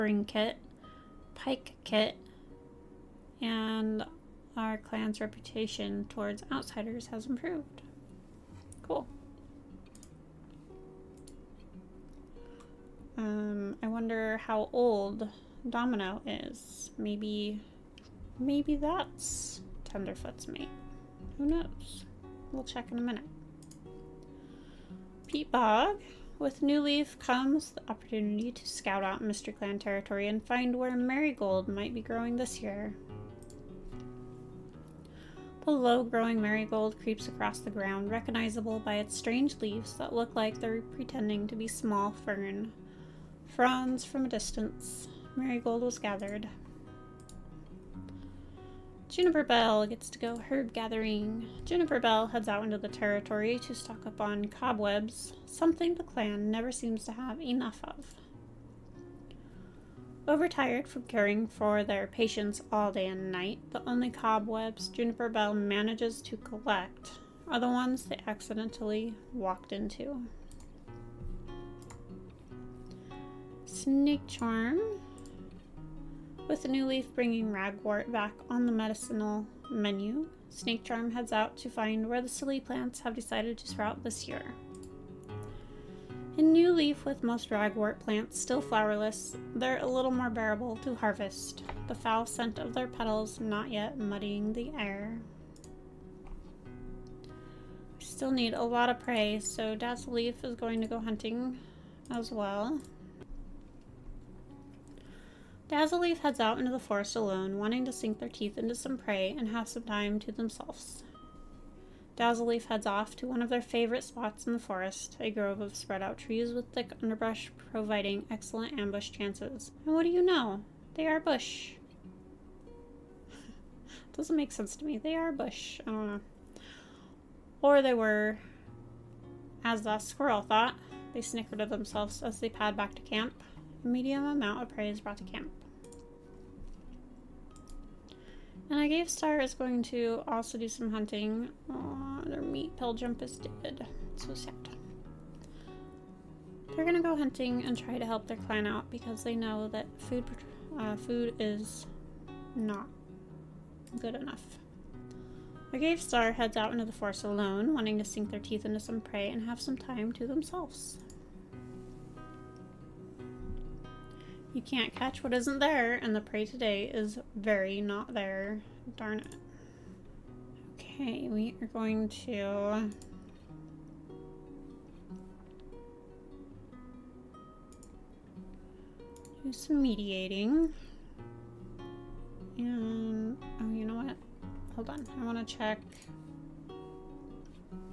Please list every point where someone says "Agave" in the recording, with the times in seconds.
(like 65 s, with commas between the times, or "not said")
138 s, 155 s.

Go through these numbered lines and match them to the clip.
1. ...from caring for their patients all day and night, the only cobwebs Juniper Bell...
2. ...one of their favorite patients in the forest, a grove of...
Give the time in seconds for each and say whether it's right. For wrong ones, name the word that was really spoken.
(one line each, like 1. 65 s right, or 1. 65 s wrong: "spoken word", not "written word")
1. 60 s right
2. 113 s wrong: "spots", not "patients".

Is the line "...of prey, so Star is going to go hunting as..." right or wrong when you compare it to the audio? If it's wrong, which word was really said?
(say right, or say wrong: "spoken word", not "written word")
wrong: "Leaf", not "Star".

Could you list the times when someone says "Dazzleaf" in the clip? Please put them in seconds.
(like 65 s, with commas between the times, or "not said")
105 s, 112 s.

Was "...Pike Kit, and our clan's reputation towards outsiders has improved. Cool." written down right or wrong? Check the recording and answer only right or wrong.
right.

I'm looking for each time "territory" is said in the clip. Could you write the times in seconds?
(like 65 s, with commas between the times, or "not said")
29 s, 52 s.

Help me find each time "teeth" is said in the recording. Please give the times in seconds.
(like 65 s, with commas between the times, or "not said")
108 s, 158 s.